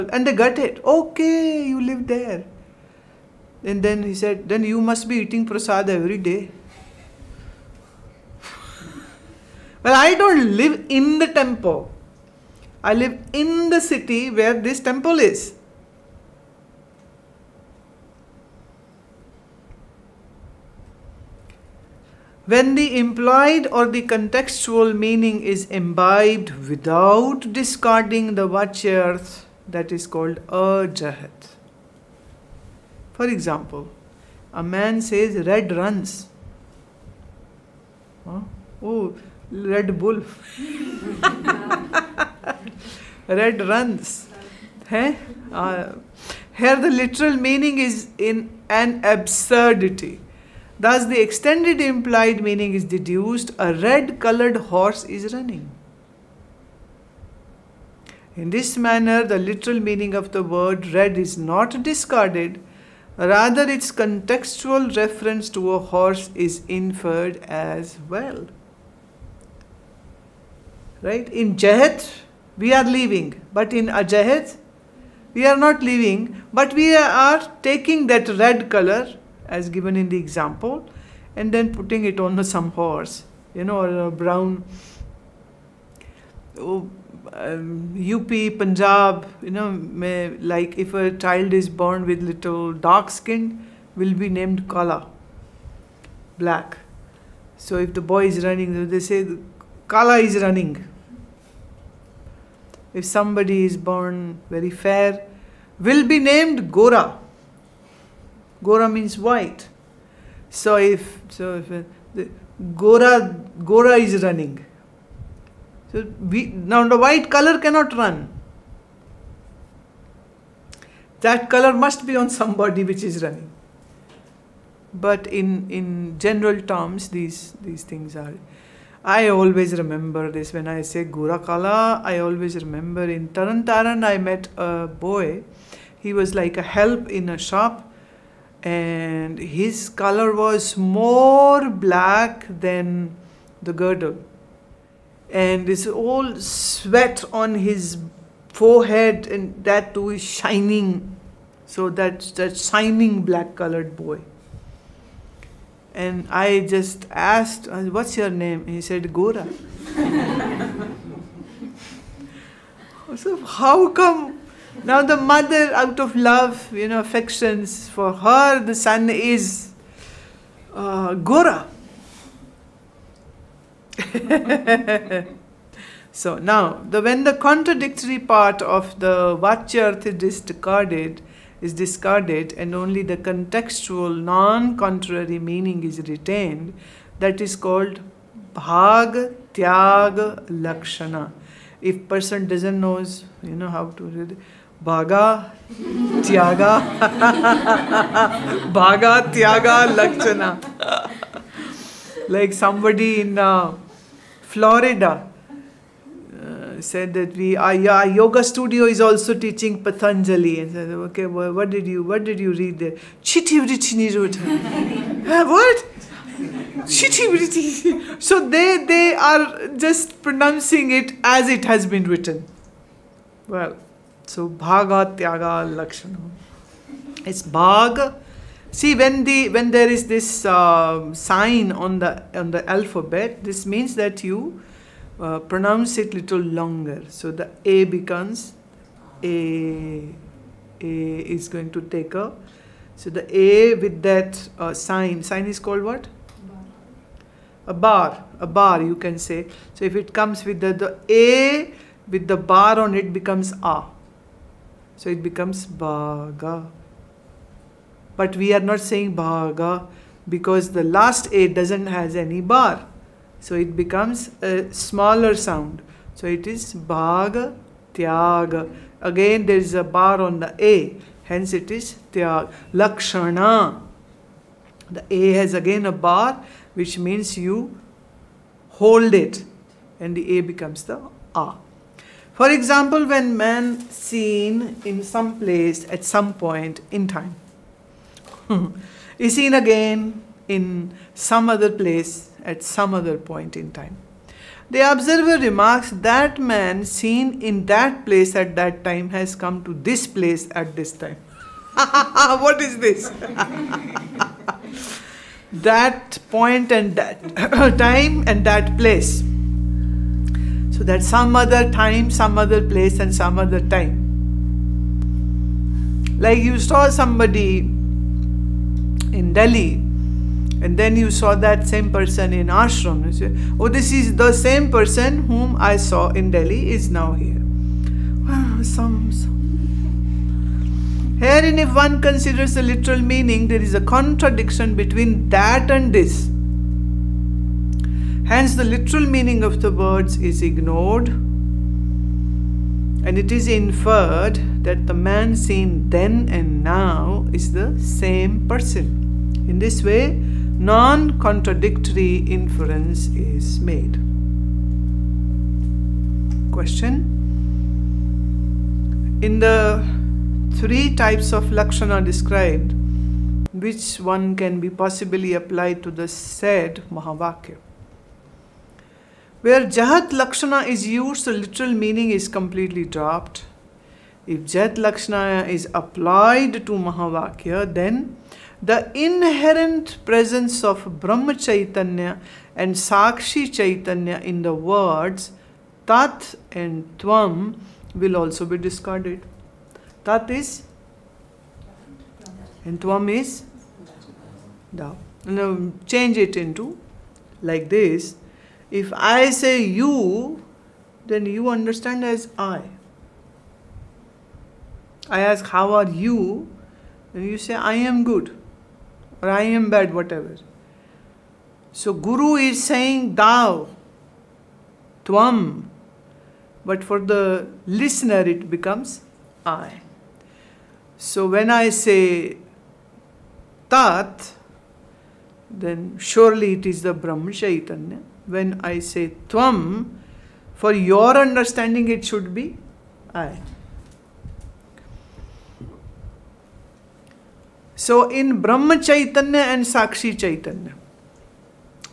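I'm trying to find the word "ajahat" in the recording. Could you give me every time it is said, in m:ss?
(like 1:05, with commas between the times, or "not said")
0:30, 1:13.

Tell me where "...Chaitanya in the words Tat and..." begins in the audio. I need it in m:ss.
6:23.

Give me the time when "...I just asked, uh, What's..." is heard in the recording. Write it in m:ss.
2:36.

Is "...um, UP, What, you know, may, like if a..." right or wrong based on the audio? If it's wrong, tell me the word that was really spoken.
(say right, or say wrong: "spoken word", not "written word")
wrong: "Punjab", not "What".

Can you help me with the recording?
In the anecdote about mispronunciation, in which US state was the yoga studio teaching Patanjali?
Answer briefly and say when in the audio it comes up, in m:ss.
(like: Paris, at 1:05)
Florida, at 3:24.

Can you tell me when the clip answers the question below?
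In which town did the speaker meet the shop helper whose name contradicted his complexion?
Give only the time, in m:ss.
2:13.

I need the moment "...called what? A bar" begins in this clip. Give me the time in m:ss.
4:05.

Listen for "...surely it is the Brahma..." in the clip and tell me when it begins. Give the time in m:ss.
7:05.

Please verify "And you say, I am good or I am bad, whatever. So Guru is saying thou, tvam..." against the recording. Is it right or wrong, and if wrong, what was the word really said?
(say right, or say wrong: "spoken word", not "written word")
right.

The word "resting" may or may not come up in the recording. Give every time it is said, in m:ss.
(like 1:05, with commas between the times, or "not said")
not said.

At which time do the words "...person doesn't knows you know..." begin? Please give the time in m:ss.
3:12.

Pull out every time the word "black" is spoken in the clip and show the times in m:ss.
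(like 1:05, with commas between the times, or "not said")
1:36, 2:21, 2:33.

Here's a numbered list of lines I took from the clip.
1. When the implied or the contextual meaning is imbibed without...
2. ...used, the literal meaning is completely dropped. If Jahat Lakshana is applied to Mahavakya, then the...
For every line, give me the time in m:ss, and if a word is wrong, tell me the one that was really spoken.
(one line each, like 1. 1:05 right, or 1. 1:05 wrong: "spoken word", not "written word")
1. 0:22 right
2. 6:10 right.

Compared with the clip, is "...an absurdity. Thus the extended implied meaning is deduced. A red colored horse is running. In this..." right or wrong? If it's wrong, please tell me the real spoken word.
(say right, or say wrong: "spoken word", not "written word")
right.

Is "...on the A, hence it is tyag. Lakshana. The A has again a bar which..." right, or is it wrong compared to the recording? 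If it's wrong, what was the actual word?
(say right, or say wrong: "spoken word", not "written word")
right.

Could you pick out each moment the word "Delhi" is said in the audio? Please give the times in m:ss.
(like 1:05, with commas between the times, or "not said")
5:19, 5:26.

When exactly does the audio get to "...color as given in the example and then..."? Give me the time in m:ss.
1:18.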